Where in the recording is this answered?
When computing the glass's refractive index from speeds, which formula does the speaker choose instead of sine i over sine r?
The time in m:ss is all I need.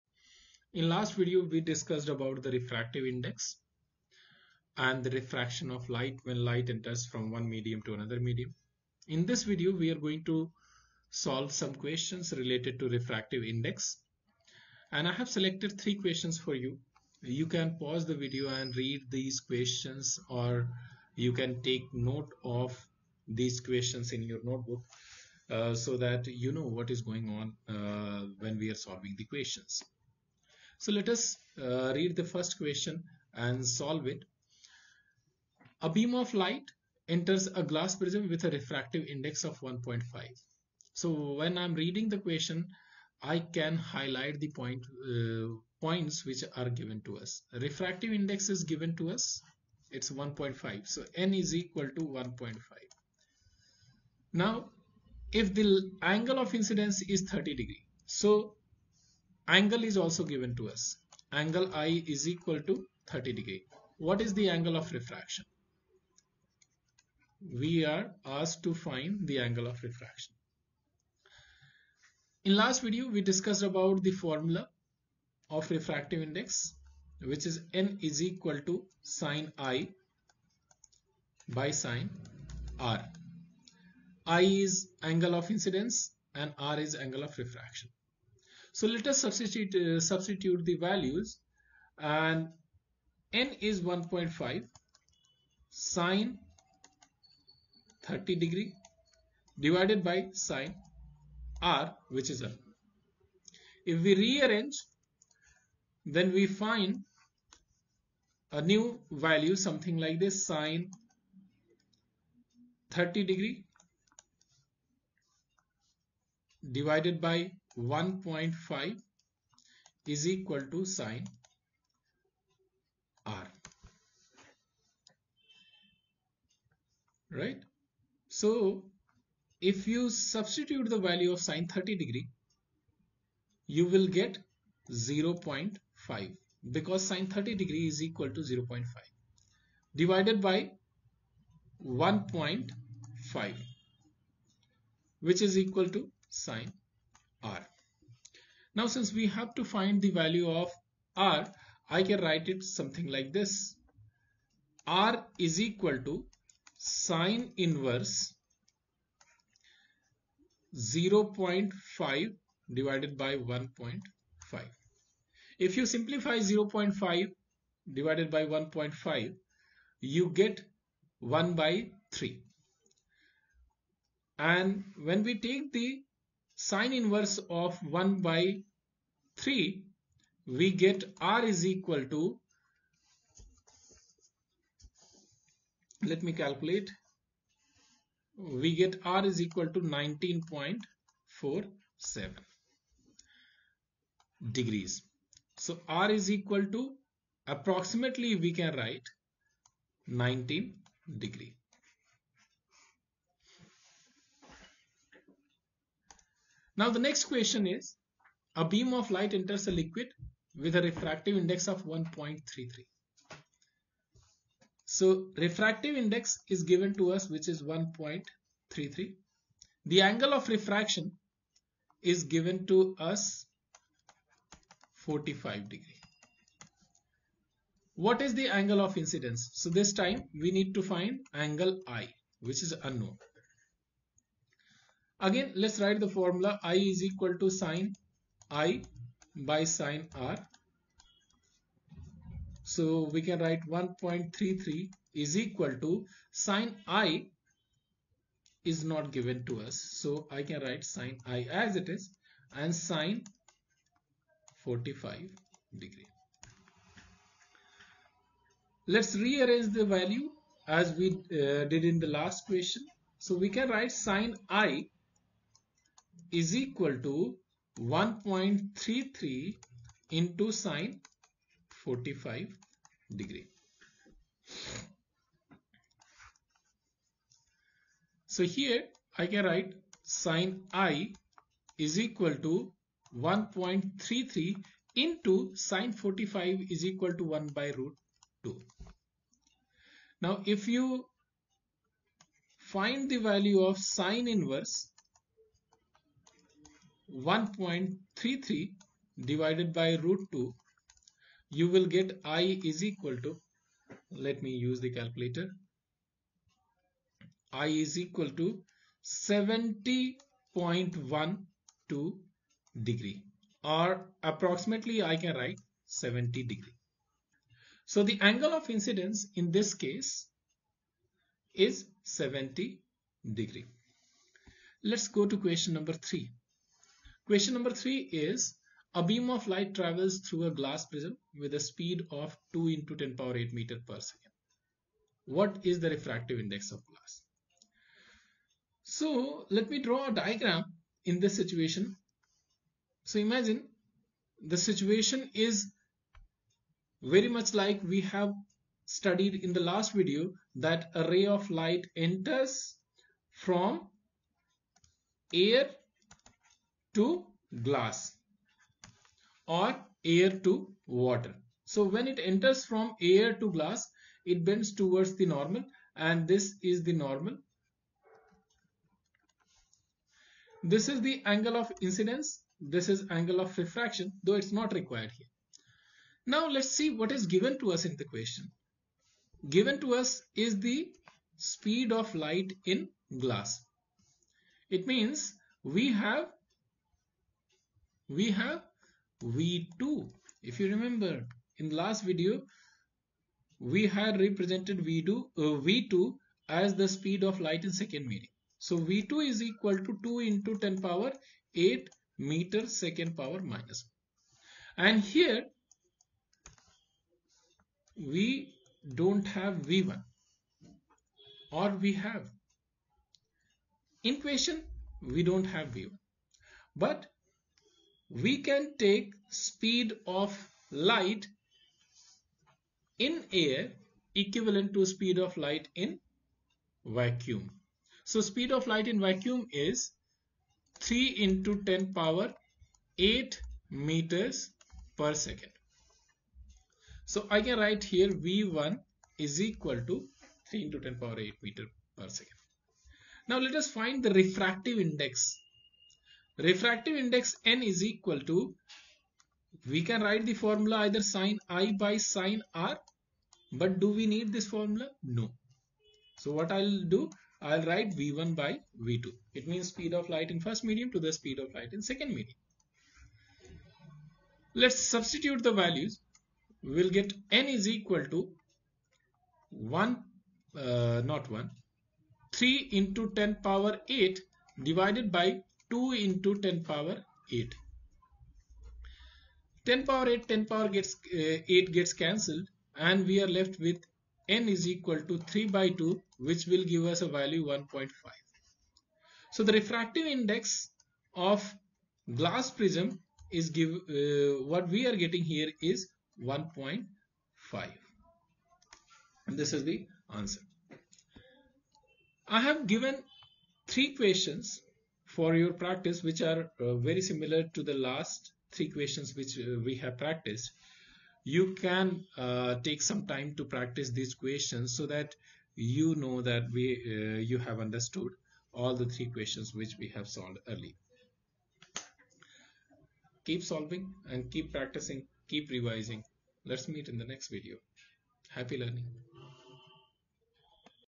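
7:37.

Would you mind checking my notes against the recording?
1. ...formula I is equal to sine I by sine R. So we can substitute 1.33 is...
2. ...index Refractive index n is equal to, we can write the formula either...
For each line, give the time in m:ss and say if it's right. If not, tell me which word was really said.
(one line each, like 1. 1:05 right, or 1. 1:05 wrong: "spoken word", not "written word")
1. 3:56 wrong: "write", not "substitute"
2. 7:24 right.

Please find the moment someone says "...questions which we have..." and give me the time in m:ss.
8:39.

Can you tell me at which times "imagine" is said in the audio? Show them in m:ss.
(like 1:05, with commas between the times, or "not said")
5:43.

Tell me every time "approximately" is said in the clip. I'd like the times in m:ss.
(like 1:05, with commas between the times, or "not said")
3:17, 5:14.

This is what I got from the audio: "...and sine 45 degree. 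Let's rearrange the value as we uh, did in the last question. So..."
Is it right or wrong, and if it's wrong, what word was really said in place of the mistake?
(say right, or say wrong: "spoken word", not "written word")
right.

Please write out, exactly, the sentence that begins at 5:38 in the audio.
So let me draw a diagram in this situation.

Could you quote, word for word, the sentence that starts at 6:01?
So when it enters from air to glass, it bends towards the normal and this is the normal.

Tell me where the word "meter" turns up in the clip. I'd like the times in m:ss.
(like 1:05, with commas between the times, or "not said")
5:33, 6:38, 6:42, 7:13, 7:21.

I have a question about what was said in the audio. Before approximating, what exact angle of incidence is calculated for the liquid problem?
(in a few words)
70.12 degrees.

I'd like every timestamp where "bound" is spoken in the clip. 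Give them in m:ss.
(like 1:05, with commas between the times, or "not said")
not said.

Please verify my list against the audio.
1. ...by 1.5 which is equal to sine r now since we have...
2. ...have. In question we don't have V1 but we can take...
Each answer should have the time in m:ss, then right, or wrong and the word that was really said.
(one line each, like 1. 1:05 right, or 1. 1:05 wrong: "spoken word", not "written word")
1. 2:20 right
2. 6:51 right.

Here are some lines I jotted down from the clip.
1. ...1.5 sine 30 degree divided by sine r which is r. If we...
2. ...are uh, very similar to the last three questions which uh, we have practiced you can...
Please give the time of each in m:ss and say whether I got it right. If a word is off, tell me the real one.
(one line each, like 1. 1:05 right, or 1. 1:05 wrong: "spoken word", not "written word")
1. 1:33 right
2. 8:26 right.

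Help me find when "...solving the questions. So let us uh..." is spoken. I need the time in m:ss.
0:28.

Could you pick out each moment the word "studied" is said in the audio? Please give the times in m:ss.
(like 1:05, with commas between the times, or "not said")
5:48.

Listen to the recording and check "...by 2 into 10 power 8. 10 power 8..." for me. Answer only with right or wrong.
right.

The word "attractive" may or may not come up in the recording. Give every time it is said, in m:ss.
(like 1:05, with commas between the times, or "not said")
not said.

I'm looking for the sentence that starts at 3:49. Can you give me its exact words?
So this time we need to find angle I which is unknown.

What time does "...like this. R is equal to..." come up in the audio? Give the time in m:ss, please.
2:33.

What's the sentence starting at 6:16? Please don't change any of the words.
Now let's see what is given to us in the question.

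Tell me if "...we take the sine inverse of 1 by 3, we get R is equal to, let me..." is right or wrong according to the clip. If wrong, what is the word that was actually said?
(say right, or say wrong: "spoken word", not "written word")
right.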